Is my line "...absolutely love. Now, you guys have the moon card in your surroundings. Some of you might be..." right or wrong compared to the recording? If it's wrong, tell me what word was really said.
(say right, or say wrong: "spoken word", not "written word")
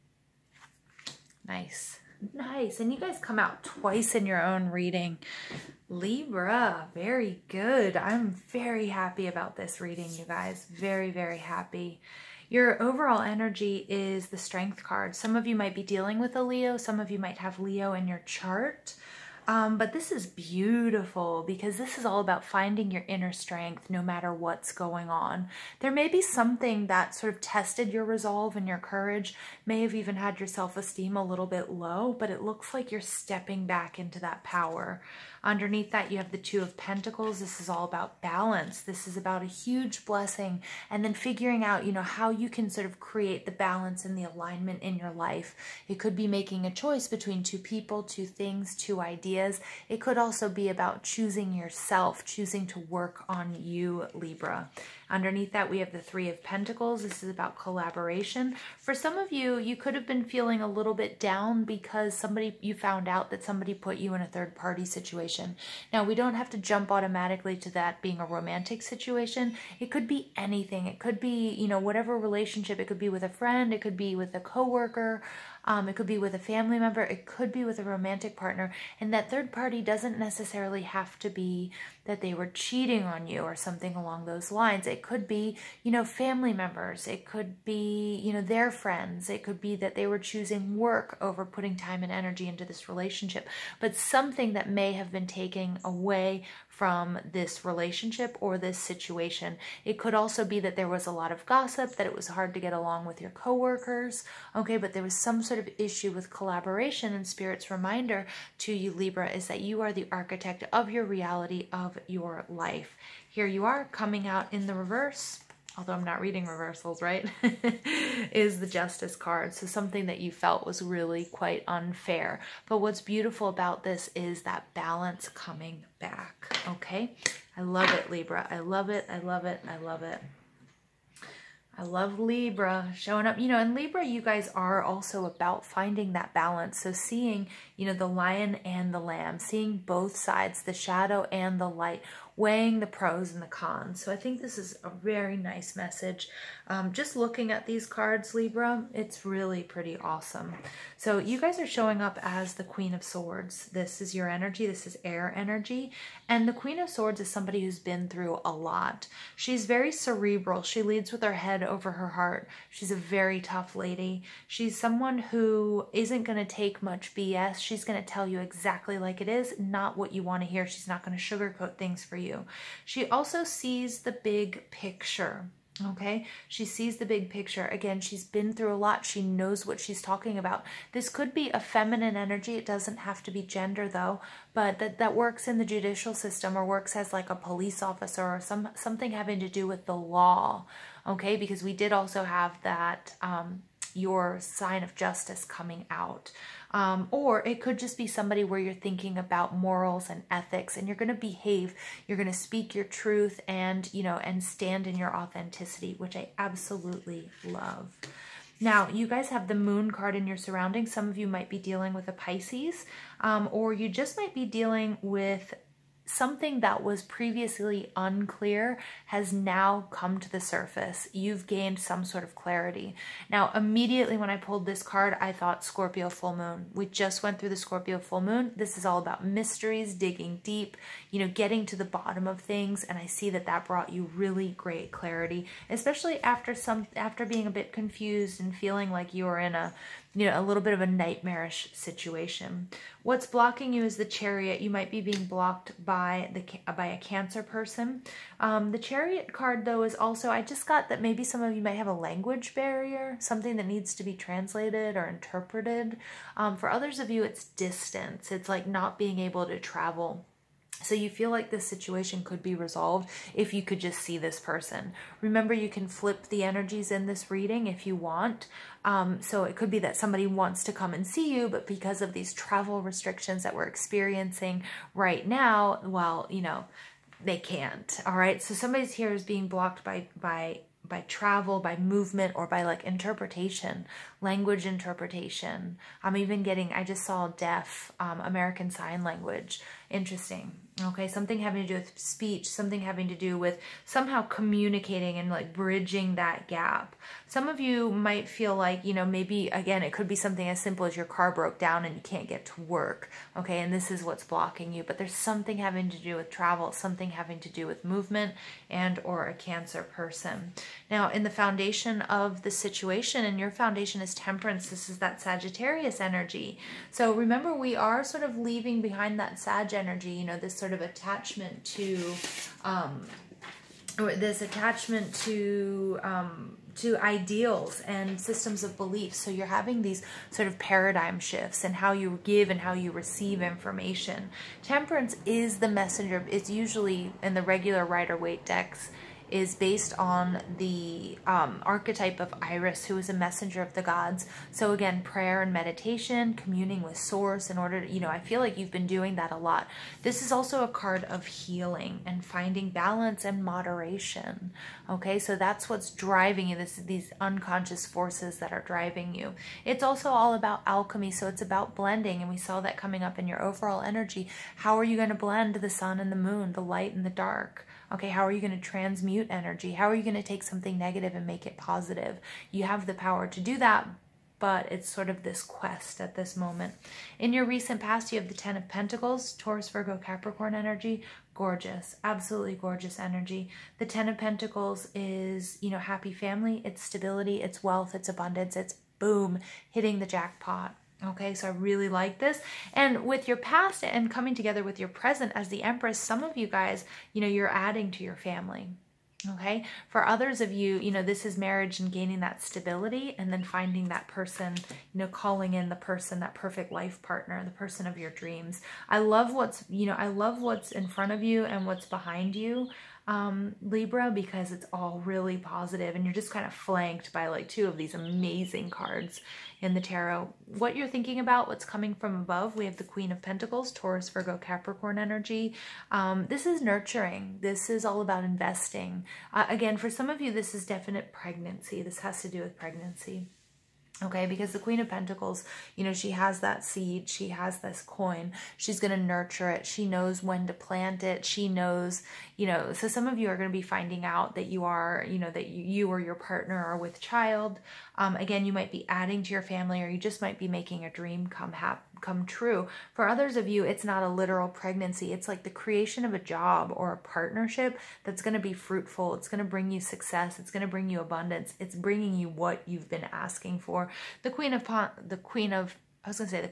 right.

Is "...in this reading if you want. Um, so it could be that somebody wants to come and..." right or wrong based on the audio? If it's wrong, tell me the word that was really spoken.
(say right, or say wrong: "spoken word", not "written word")
right.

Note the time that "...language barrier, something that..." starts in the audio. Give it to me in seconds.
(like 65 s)
251 s.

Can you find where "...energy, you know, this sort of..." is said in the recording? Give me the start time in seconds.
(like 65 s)
319 s.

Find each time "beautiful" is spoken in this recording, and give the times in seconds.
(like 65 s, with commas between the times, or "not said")
20 s, 123 s.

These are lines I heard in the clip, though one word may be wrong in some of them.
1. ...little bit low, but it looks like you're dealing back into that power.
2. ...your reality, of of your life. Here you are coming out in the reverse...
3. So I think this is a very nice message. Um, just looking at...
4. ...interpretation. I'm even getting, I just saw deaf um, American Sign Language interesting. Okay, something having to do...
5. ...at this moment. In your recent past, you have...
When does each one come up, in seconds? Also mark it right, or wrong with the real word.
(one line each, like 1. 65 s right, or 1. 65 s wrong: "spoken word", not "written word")
1. 31 s wrong: "stepping", not "dealing"
2. 110 s right
3. 144 s right
4. 284 s right
5. 375 s right.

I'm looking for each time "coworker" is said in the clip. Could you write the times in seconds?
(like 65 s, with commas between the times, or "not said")
74 s, 103 s.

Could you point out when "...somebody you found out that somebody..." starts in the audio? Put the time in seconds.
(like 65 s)
62 s.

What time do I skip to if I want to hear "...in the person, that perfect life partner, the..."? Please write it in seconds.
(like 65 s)
405 s.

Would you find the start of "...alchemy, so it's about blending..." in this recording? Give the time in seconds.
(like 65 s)
360 s.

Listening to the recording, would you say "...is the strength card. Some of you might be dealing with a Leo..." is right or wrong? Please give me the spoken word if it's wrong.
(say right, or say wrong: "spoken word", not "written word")
right.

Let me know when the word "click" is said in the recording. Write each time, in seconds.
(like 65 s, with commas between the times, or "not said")
not said.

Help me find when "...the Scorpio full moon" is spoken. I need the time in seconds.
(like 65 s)
227 s.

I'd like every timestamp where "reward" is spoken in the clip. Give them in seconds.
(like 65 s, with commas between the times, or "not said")
not said.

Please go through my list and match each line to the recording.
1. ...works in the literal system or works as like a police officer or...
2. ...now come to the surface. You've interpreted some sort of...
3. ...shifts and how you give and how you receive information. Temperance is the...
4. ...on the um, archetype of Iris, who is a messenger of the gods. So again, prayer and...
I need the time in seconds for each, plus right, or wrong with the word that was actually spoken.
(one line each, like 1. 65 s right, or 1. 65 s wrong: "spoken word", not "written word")
1. 185 s wrong: "judicial", not "literal"
2. 219 s wrong: "gained", not "interpreted"
3. 331 s right
4. 339 s right.